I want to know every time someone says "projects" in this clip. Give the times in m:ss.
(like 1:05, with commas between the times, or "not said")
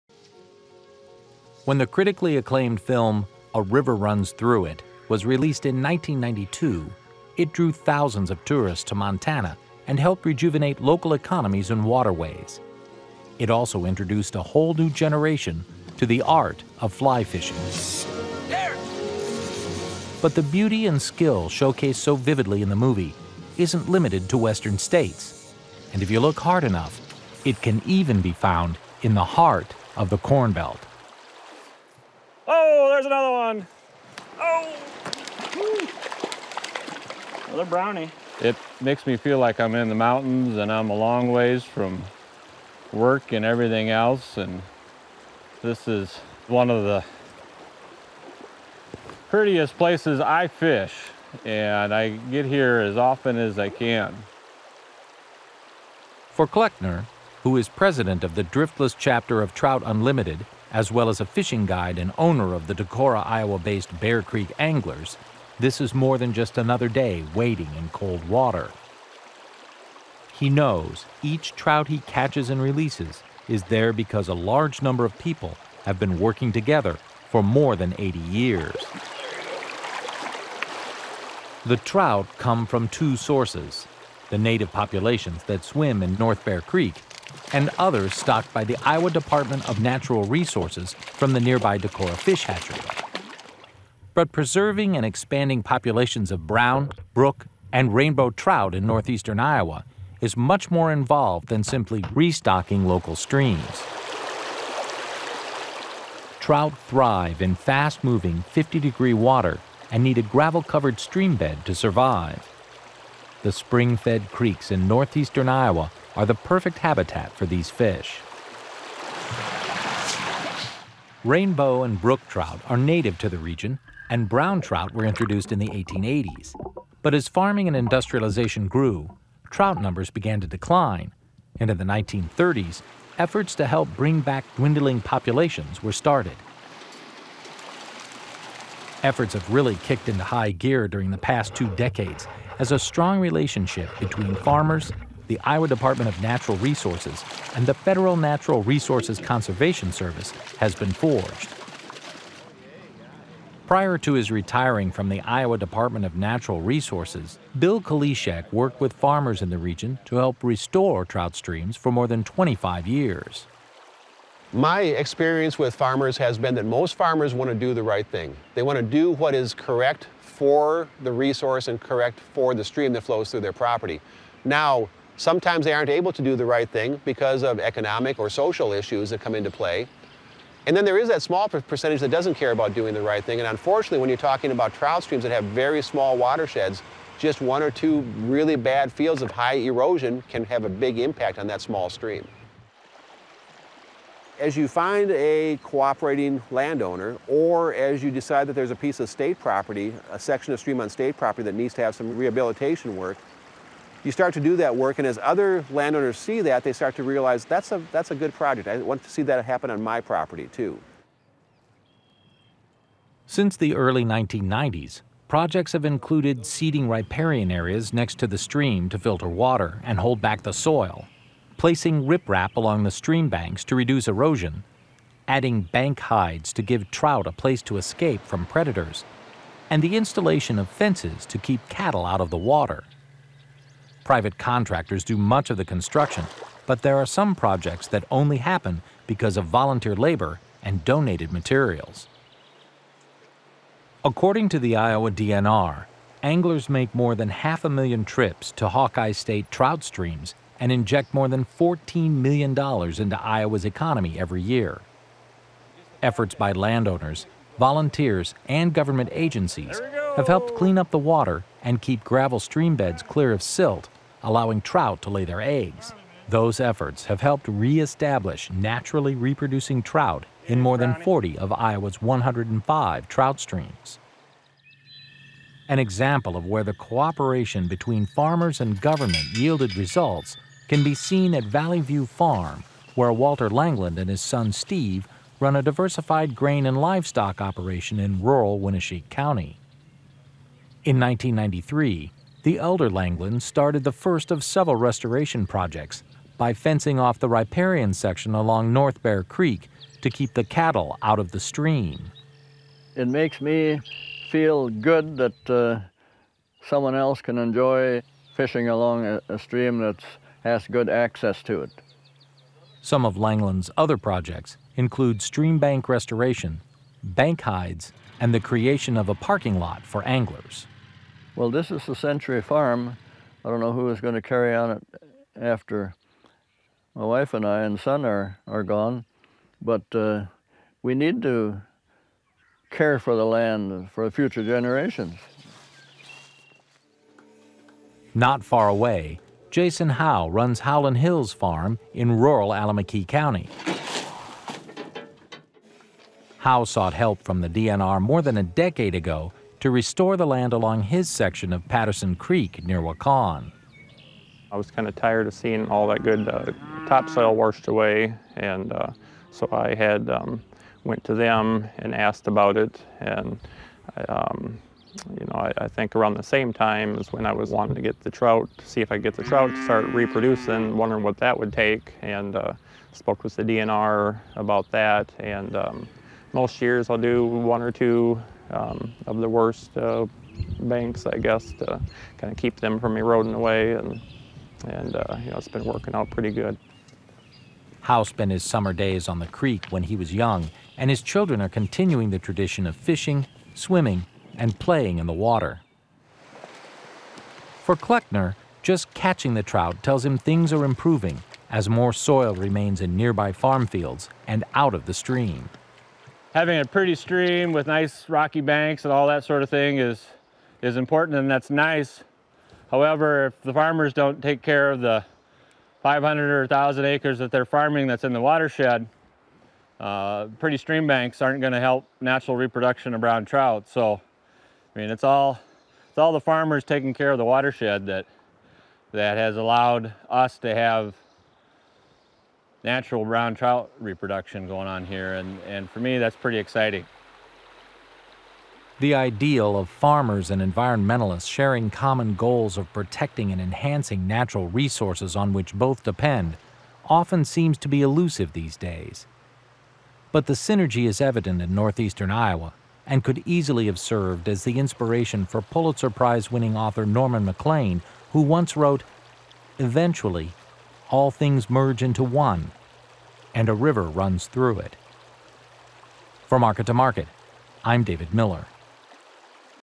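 3:28, 3:35, 3:57, 4:55, 5:13.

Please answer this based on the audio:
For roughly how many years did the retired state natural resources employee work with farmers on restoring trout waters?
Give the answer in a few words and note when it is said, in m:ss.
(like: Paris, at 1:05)
25 years, at 2:41.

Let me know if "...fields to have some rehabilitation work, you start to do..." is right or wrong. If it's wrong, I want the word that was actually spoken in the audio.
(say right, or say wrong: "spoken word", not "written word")
wrong: "needs", not "fields".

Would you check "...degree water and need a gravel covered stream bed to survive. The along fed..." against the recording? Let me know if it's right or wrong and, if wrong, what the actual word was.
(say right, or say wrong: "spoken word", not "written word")
wrong: "spring", not "along".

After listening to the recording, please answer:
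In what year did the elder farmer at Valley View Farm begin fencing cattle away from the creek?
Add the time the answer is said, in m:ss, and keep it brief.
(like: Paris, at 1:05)
1993, at 4:50.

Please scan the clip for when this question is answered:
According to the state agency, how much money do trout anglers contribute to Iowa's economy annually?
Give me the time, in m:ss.
4:11.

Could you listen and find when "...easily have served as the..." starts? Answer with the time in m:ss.
7:33.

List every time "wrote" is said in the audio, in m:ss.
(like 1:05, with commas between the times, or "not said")
7:38.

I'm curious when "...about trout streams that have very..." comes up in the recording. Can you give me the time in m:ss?
3:04.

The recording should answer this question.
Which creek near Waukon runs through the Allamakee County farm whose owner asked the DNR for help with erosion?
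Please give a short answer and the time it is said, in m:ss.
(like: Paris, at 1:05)
Patterson Creek, at 5:51.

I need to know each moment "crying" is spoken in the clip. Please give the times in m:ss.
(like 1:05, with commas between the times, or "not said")
not said.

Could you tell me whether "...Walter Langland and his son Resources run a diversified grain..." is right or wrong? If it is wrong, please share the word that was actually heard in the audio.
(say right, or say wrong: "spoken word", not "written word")
wrong: "Steve", not "Resources".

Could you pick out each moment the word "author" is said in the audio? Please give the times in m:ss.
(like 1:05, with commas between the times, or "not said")
7:36.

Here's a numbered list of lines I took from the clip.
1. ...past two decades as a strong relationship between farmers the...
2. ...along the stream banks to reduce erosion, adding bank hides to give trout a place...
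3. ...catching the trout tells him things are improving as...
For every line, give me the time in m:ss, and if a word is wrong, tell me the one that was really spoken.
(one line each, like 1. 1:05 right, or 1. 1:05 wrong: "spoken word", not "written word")
1. 2:21 right
2. 3:42 right
3. 6:38 right.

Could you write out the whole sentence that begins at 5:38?
Not far away, Jason Howe runs Howland Hills Farm in rural Allamakee County.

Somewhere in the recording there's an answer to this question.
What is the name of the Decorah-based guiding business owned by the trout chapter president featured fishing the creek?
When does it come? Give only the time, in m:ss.
1:03.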